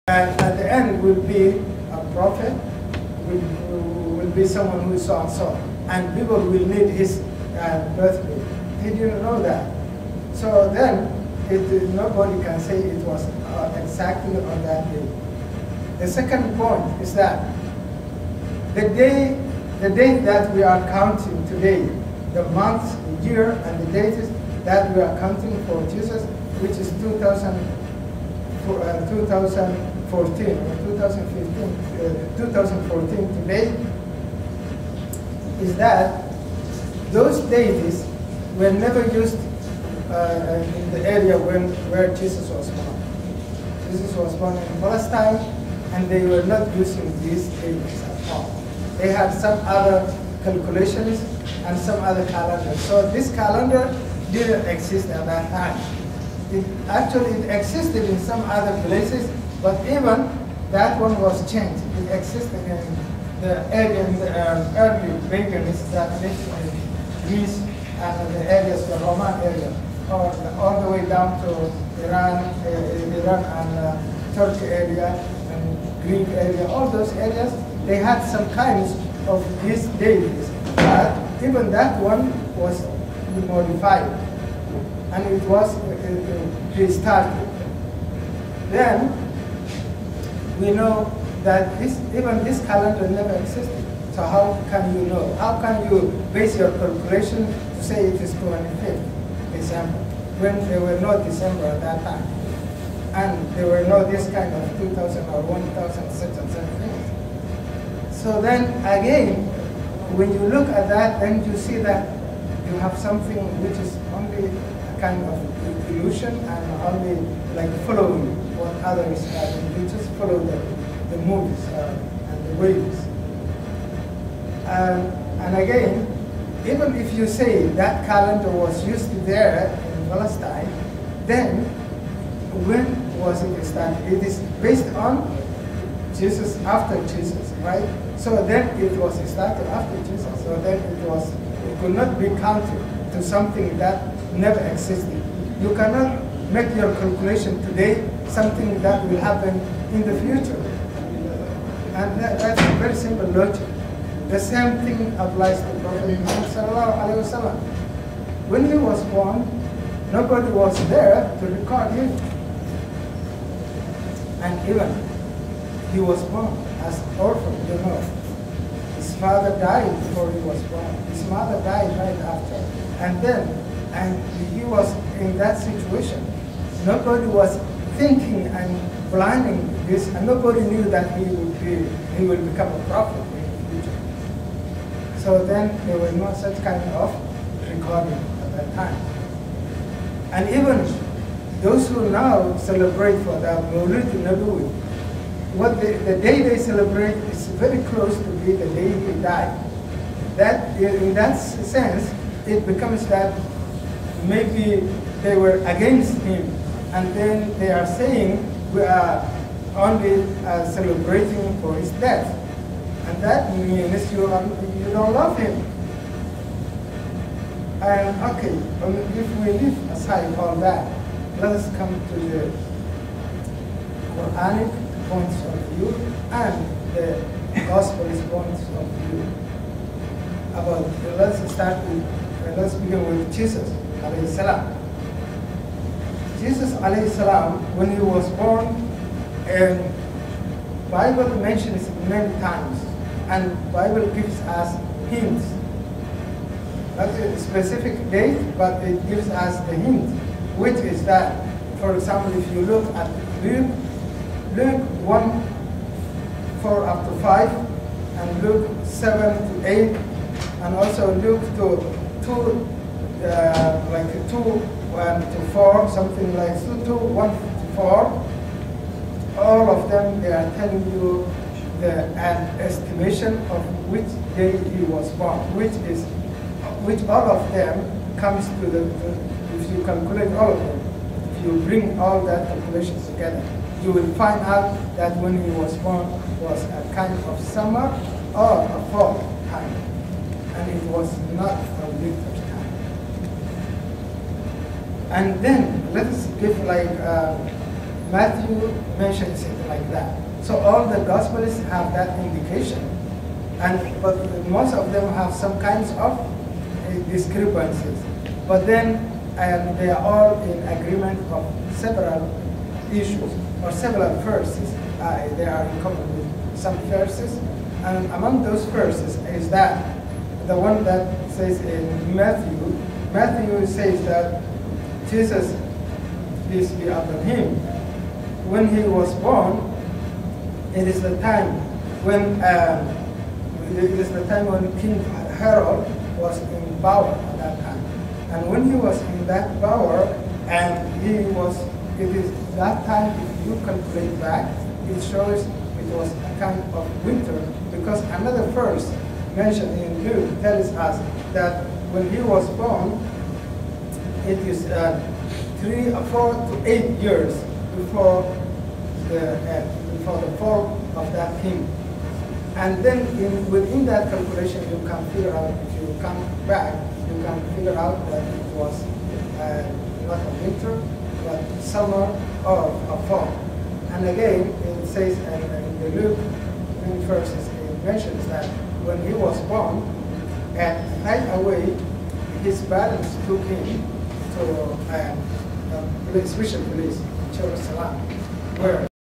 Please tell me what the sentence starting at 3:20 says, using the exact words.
That in that sense, it becomes that maybe they were against him.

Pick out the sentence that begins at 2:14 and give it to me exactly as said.
It is based on Jesus after Jesus, right?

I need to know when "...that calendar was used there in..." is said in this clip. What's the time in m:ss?
2:07.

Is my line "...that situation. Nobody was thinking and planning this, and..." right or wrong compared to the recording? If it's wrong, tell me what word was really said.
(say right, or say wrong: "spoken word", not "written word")
right.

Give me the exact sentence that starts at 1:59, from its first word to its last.
we just follow the, the moves uh, and the waves.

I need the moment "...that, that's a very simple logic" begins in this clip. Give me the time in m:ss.
2:32.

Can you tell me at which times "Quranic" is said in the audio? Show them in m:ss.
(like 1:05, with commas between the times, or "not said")
3:44.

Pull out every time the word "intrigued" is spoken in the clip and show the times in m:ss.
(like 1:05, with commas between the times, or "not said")
not said.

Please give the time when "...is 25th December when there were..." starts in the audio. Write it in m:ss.
1:38.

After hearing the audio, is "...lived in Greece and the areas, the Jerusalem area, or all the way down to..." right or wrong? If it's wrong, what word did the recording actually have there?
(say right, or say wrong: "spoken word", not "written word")
wrong: "Roman", not "Jerusalem".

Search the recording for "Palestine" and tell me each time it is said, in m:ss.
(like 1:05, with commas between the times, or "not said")
0:44, 2:10.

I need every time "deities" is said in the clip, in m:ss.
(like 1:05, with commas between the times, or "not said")
0:37, 0:47, 1:20.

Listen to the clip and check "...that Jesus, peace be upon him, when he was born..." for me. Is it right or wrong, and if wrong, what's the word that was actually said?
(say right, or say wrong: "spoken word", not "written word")
right.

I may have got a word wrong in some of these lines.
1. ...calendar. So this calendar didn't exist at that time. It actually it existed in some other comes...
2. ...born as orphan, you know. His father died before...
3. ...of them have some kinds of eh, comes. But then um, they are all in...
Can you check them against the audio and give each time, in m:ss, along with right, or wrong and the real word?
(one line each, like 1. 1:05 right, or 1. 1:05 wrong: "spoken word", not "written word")
1. 0:52 wrong: "places", not "comes"
2. 2:46 right
3. 5:04 wrong: "discrepancies", not "comes".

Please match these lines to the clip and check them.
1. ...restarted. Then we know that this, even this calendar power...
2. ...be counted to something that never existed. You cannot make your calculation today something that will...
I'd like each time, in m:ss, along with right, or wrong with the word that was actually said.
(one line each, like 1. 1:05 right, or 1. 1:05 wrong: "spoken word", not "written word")
1. 1:26 wrong: "never", not "power"
2. 2:22 right.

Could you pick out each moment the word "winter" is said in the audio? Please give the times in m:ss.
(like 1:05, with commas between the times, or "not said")
5:47, 6:10.